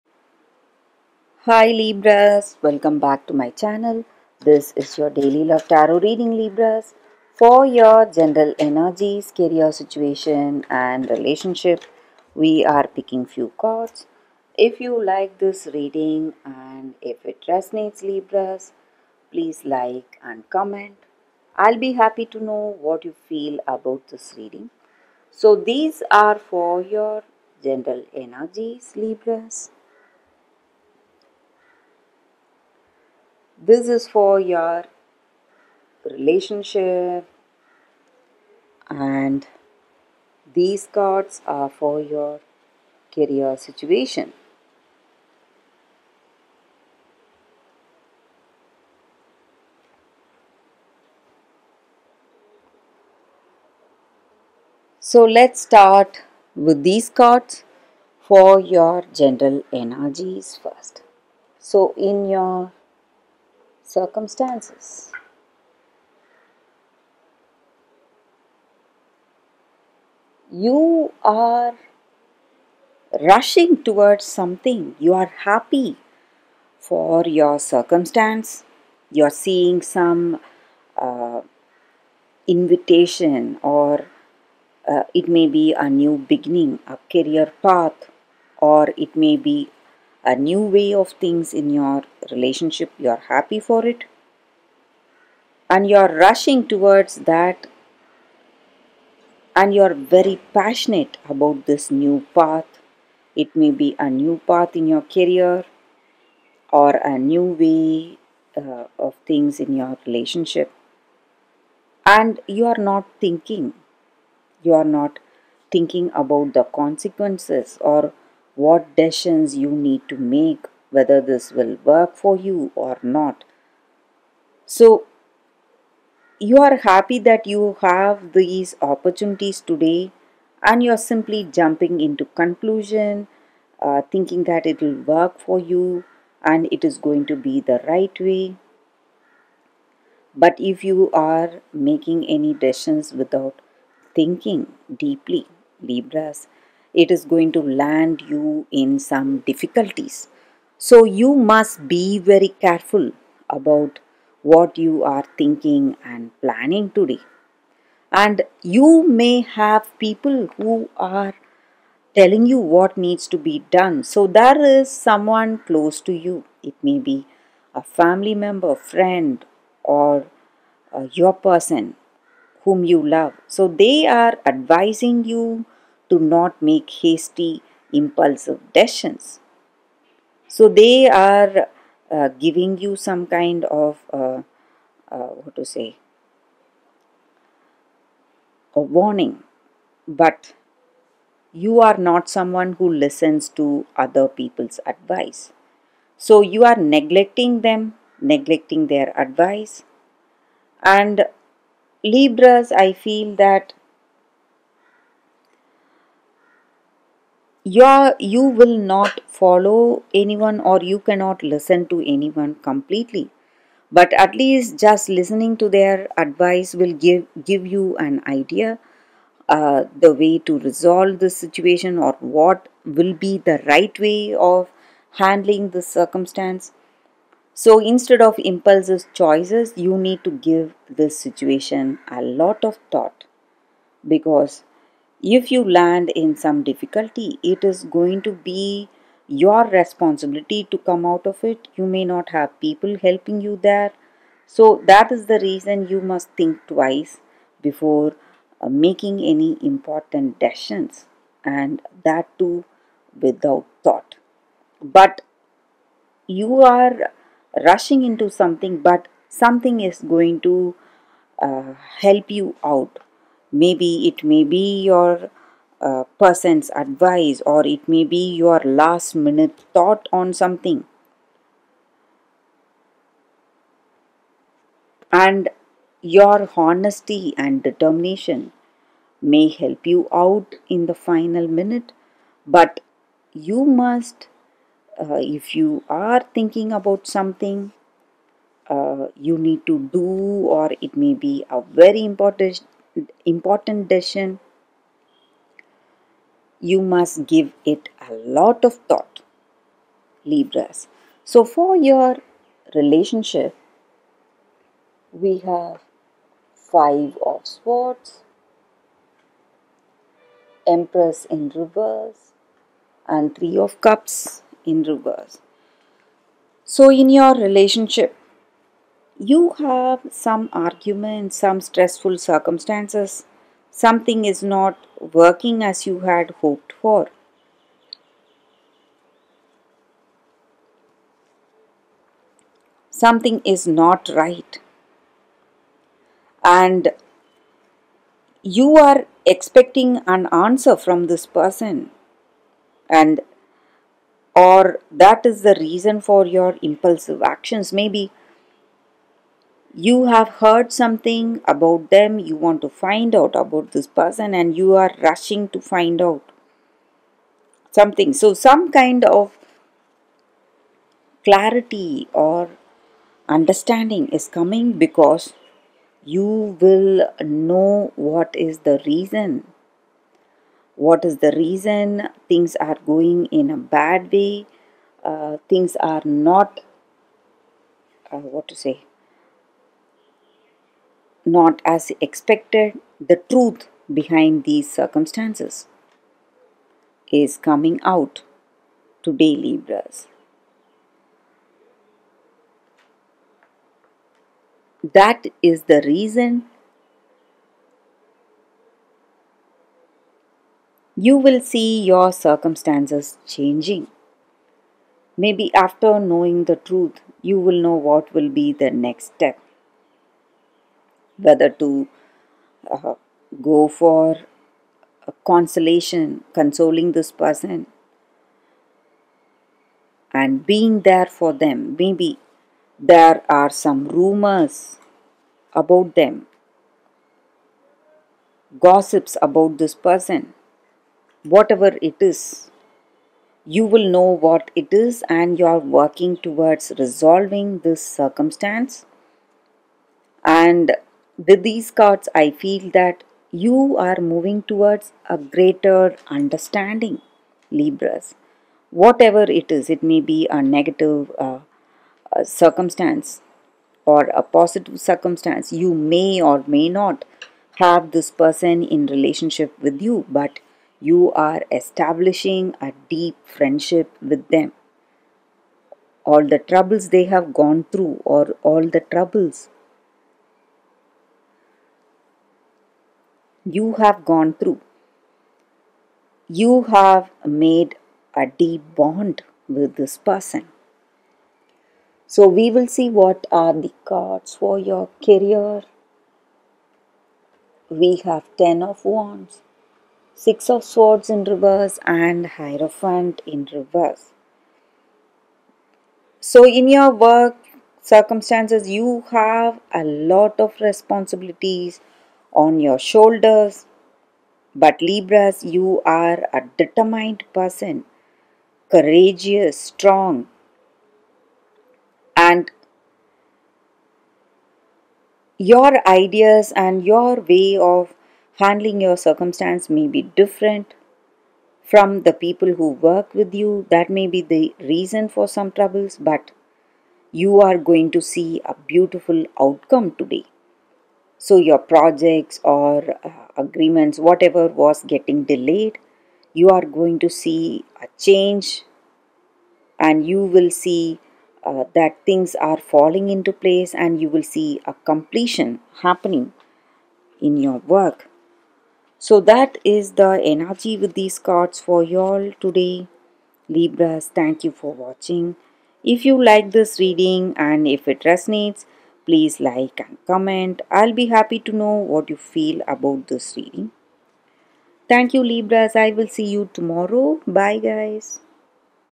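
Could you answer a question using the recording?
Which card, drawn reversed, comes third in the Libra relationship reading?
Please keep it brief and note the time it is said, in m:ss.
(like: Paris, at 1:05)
Three of Cups, at 5:13.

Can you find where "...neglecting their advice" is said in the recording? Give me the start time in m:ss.
3:18.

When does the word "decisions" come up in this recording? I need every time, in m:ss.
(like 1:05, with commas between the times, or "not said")
1:58, 2:22, 2:58, 4:10, 4:53.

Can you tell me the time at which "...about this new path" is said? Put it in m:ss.
1:41.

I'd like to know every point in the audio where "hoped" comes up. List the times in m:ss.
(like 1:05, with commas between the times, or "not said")
5:26.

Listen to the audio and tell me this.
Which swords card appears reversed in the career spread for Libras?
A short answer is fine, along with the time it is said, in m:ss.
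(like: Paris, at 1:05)
6 of Swords, at 8:10.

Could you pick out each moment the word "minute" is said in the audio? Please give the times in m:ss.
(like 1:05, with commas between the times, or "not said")
4:29, 4:41.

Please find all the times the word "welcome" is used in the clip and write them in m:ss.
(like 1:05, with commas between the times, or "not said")
0:02.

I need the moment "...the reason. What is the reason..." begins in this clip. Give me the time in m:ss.
6:08.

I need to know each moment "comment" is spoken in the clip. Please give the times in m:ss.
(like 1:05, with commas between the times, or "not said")
0:20, 9:20.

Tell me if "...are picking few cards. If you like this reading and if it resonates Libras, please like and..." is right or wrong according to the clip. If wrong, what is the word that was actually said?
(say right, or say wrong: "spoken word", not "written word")
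right.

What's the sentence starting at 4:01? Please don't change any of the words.
You may not have people helping you there.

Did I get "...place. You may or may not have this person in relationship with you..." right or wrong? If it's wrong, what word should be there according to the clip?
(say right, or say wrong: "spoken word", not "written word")
wrong: "circumstance", not "place".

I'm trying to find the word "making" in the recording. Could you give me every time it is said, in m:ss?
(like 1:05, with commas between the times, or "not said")
2:21, 4:08.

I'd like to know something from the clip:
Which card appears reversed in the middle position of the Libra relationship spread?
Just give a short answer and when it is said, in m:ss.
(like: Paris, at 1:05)
Empress, at 5:10.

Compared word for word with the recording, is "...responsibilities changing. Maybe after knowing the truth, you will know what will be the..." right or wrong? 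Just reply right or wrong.
wrong.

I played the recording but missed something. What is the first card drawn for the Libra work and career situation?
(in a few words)
10 of Wands.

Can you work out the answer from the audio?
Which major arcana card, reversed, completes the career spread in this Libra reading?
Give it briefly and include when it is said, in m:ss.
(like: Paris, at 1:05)
Hierophant, at 8:12.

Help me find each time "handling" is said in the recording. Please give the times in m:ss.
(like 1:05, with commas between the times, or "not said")
3:45, 8:38.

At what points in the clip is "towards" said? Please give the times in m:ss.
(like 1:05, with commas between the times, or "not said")
1:13, 1:36, 7:16, 7:24.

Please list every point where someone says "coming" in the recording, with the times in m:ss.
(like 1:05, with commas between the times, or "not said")
6:04, 6:27.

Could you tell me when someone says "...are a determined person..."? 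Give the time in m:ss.
8:25.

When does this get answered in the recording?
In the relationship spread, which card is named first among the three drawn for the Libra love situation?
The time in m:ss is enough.
5:06.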